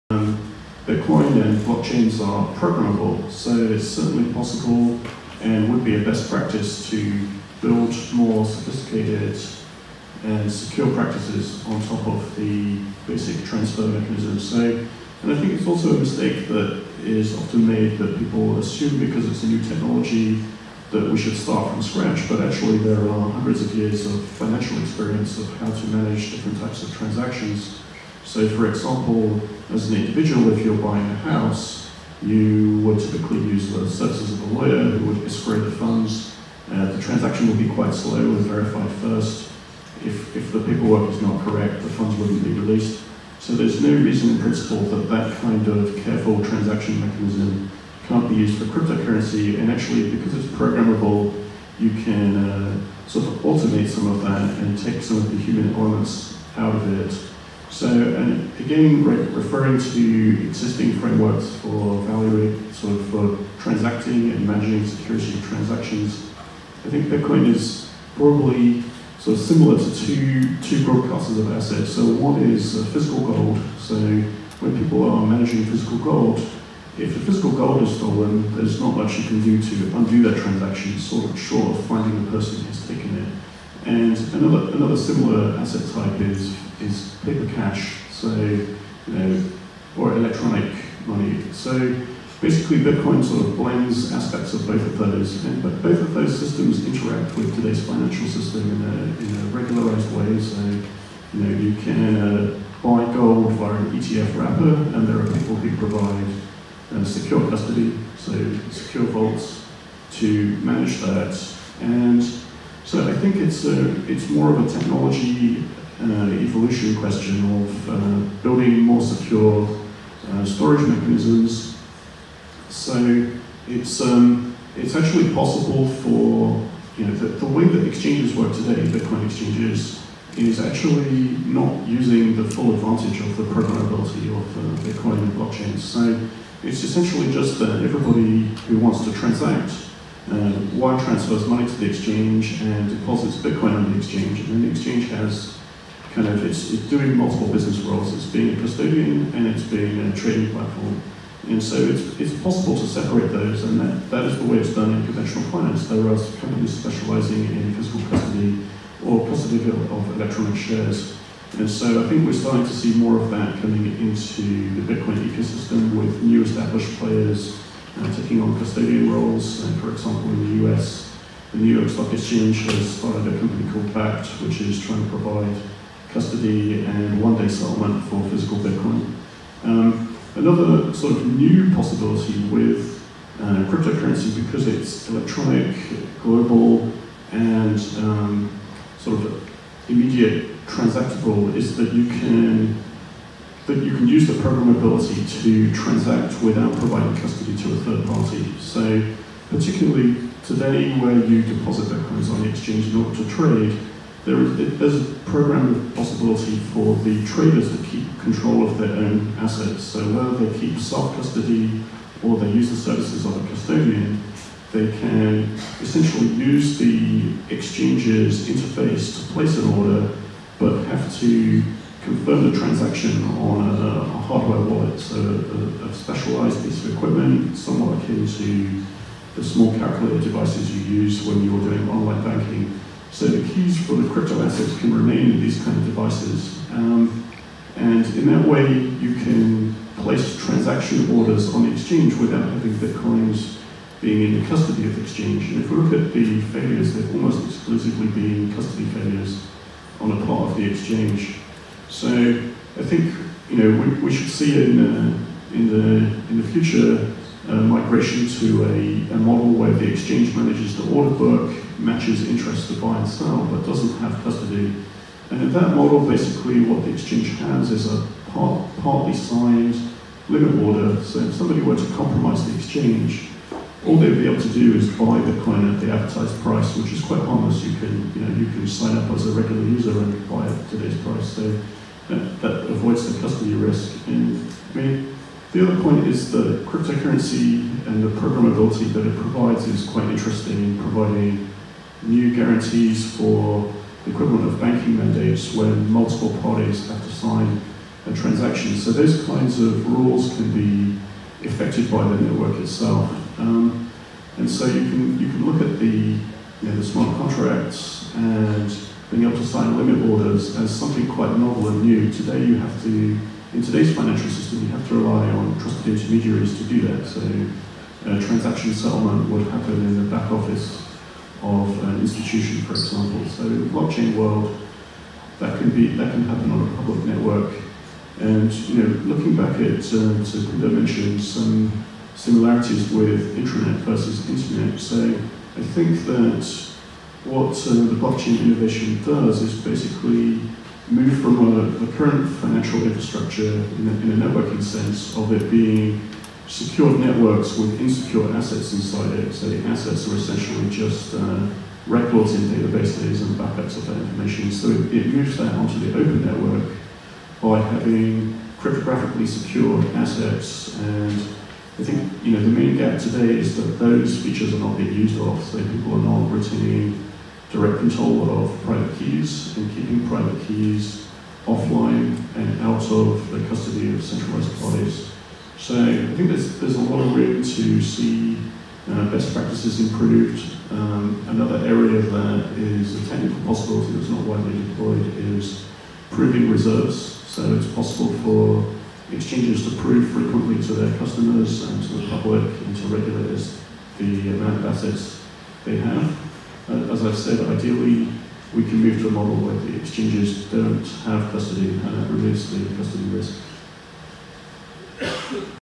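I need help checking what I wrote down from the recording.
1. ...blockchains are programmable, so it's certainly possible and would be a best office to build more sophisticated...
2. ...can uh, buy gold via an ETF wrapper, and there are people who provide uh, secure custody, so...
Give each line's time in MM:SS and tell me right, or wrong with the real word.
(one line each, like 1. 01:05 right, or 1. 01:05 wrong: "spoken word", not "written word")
1. 00:01 wrong: "practice", not "office"
2. 01:41 right.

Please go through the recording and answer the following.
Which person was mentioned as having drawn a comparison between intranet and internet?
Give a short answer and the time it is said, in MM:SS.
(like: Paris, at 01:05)
Linda, at 05:30.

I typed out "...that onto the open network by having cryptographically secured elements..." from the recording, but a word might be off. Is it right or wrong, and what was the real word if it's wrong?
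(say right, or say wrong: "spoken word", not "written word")
wrong: "assets", not "elements".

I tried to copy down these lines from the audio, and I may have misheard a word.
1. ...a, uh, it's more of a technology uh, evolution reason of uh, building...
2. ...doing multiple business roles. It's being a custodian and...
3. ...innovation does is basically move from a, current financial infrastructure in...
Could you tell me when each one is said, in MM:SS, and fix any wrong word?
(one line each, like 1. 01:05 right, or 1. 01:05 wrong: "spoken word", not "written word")
1. 01:53 wrong: "question", not "reason"
2. 02:26 right
3. 05:38 right.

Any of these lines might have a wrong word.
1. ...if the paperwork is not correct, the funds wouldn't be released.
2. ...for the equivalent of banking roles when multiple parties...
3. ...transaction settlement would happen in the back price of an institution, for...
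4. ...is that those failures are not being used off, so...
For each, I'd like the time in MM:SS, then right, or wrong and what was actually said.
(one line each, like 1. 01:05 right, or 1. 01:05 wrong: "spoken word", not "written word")
1. 00:40 right
2. 04:53 wrong: "mandates", not "roles"
3. 05:18 wrong: "office", not "price"
4. 06:03 wrong: "features", not "failures".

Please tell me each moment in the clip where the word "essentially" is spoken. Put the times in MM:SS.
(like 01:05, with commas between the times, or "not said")
02:16, 03:35, 05:50.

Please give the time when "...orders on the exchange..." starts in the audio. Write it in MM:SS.
04:01.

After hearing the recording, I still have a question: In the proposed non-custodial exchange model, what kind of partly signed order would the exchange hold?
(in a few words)
Limit order.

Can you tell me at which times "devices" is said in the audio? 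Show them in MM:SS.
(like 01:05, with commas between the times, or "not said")
03:50, 03:55.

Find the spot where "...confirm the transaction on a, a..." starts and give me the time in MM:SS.
03:42.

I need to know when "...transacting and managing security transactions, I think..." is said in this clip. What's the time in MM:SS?
01:03.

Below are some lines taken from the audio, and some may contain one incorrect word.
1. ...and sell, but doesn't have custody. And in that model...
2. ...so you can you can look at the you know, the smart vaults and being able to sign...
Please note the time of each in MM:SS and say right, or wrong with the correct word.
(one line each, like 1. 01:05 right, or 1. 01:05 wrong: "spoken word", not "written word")
1. 04:22 right
2. 05:04 wrong: "contracts", not "vaults".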